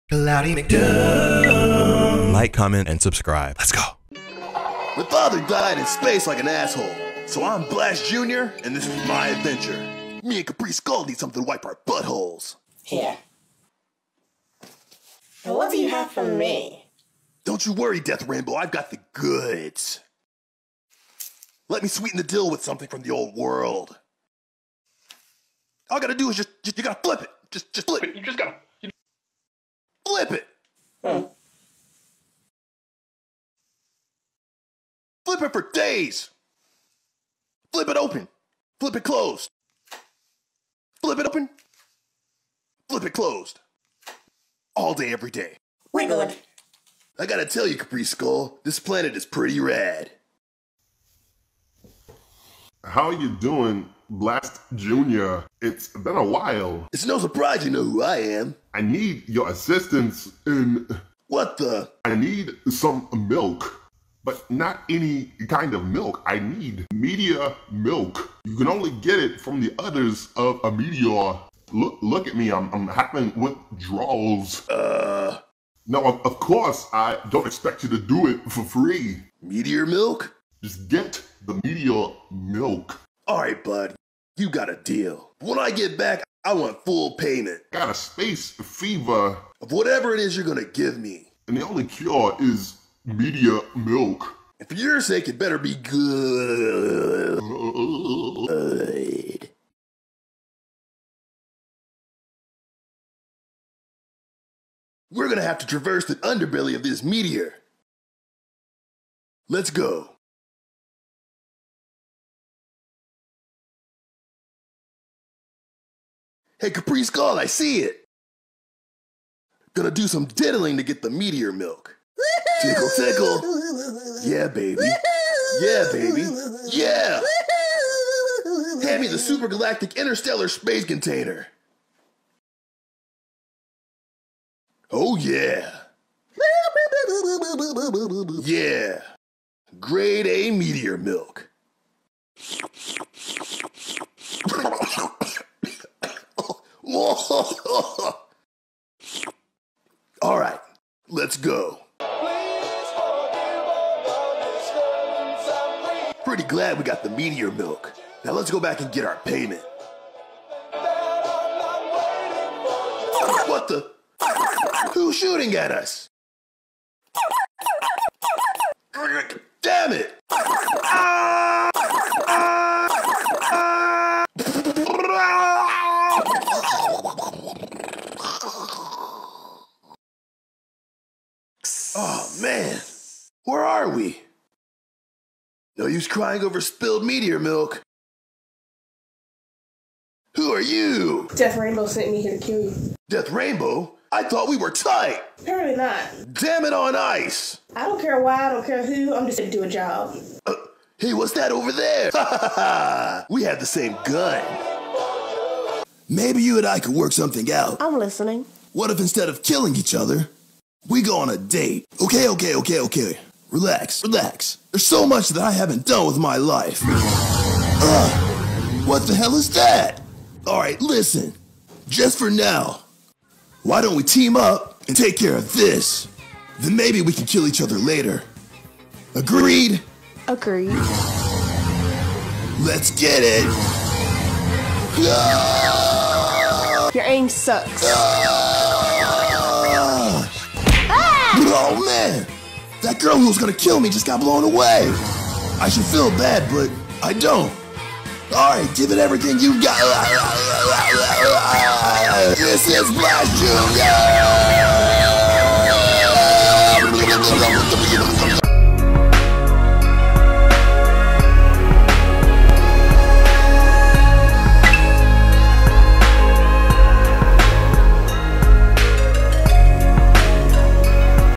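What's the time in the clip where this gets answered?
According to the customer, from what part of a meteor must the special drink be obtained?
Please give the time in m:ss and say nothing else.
1:09.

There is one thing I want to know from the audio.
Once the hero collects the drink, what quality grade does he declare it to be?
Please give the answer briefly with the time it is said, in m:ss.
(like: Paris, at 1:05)
Grade A, at 2:19.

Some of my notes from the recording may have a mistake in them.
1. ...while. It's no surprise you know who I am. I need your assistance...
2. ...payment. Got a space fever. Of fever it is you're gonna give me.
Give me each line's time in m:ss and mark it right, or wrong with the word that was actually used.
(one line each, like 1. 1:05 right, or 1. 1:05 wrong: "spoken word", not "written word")
1. 0:56 right
2. 1:27 wrong: "whatever", not "fever".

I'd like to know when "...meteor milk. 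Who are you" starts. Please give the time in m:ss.
3:07.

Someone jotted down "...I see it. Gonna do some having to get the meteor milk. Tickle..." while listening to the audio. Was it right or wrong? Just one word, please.
wrong.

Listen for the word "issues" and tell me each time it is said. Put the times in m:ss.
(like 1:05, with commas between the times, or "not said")
not said.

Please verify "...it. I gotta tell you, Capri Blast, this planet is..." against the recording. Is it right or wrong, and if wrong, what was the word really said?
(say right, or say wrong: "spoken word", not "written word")
wrong: "Skull", not "Blast".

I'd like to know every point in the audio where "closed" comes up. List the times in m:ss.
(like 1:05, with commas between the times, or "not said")
0:39, 0:43.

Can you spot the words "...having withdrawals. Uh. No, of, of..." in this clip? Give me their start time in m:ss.
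1:12.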